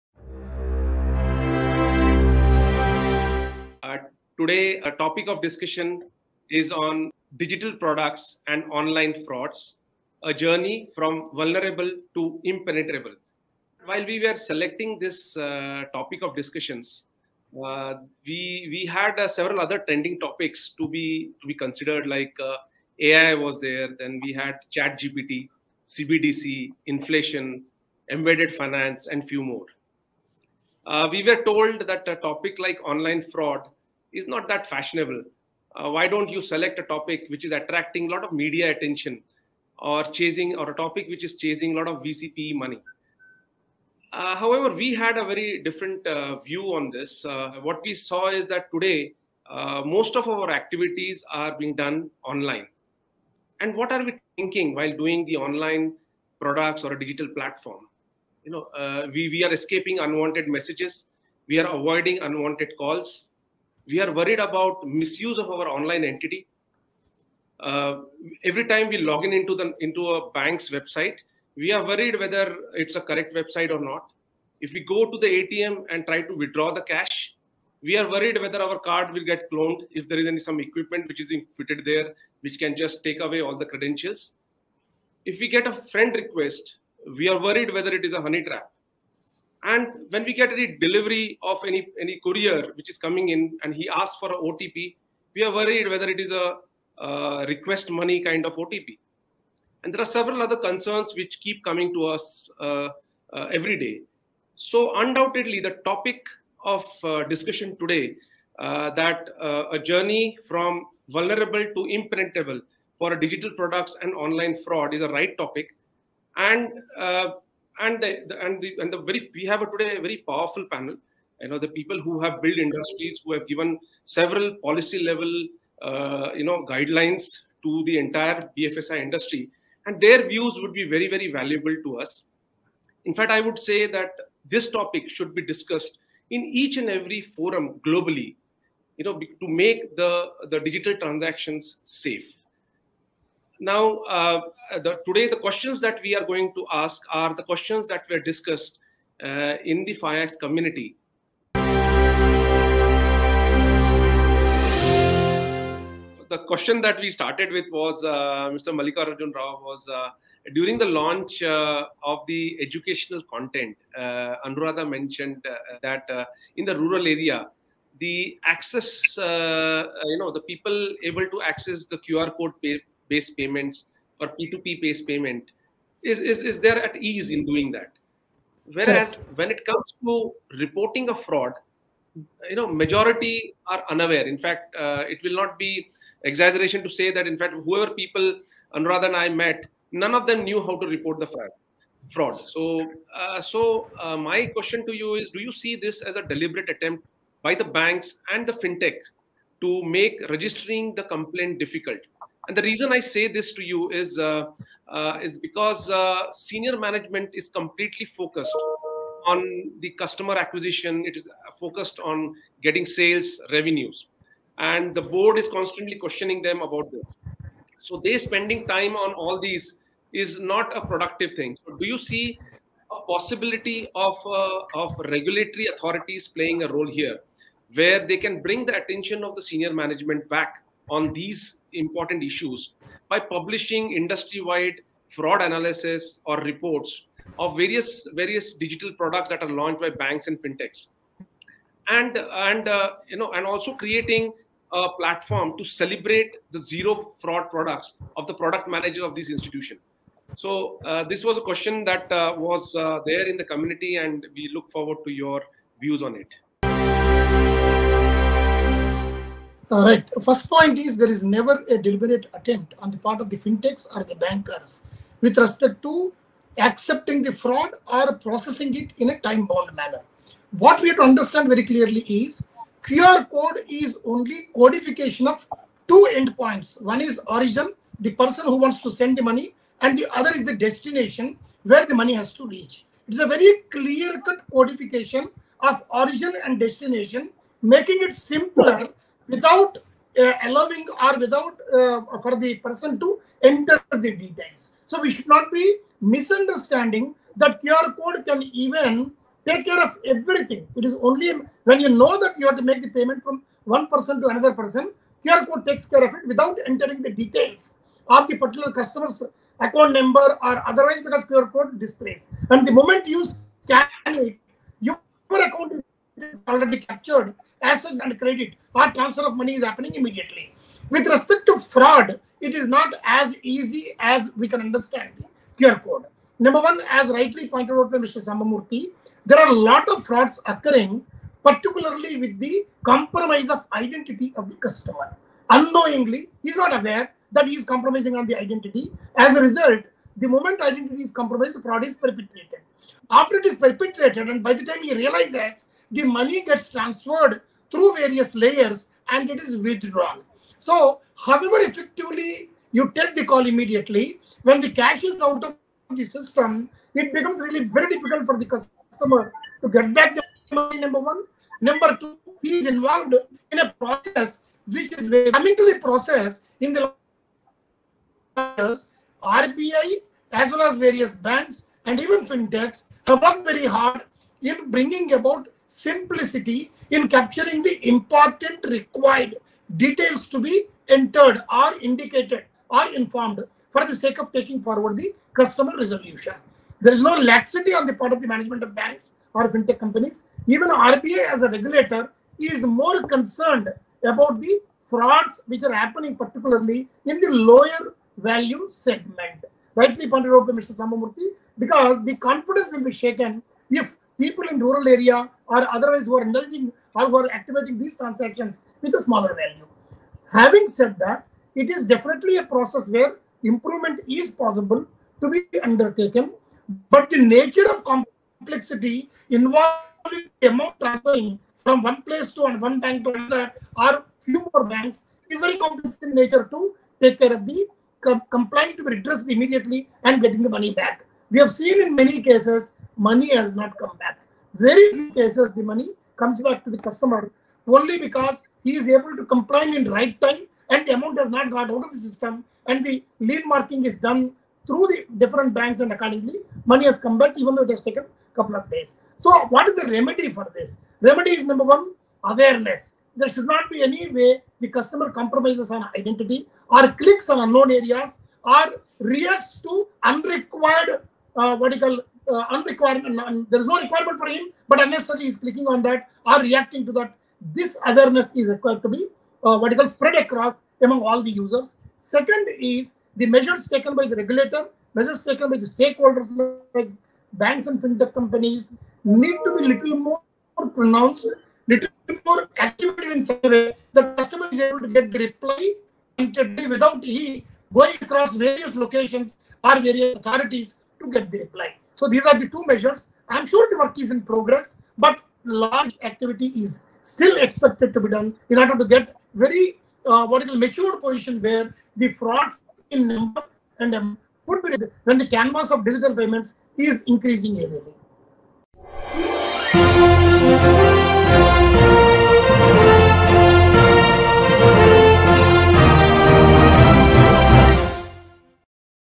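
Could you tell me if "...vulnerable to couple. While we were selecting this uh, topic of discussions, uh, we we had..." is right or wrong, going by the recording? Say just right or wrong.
wrong.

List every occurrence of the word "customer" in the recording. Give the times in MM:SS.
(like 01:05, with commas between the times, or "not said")
03:29, 05:08, 05:34, 05:58, 06:25, 07:16, 07:34, 08:04.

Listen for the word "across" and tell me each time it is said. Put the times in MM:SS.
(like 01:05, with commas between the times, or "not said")
07:50, 08:08.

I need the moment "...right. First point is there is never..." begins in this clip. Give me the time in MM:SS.
04:19.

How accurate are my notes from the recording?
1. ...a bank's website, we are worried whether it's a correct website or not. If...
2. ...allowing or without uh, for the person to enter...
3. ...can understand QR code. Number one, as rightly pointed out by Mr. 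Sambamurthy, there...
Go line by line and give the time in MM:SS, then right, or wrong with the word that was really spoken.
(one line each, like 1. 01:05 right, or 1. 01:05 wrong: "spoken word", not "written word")
1. 01:10 right
2. 04:50 right
3. 05:24 right.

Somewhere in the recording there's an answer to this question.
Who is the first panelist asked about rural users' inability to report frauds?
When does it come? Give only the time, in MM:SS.
02:38.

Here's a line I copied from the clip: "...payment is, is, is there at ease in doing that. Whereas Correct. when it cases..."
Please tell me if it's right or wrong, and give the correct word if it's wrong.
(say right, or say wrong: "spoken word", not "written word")
wrong: "comes", not "cases".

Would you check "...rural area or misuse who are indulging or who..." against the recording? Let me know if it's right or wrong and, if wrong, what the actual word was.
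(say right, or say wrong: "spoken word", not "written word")
wrong: "otherwise", not "misuse".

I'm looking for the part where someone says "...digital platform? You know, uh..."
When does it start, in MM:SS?
00:56.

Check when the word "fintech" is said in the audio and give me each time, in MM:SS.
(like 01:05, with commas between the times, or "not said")
03:18, 04:00, 04:23, 06:12, 06:29, 07:57.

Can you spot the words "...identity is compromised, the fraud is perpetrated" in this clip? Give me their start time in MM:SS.
05:40.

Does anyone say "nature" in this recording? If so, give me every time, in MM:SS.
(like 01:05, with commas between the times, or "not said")
06:57, 07:06.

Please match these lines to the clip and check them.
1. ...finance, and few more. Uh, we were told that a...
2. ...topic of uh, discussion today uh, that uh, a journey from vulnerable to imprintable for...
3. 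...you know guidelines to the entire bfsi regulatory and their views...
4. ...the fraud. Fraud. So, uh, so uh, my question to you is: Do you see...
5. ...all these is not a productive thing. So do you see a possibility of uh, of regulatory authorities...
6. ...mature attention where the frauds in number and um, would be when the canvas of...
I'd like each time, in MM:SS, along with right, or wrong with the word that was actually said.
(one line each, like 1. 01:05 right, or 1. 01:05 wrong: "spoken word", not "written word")
1. 00:28 right
2. 01:45 right
3. 02:06 wrong: "industry", not "regulatory"
4. 03:11 right
5. 03:39 right
6. 08:20 wrong: "position", not "attention".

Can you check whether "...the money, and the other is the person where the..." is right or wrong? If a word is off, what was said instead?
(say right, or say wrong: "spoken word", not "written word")
wrong: "destination", not "person".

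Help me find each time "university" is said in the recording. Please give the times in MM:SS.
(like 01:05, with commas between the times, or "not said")
not said.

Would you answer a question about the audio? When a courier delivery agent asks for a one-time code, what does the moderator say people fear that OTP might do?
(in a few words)
Request money.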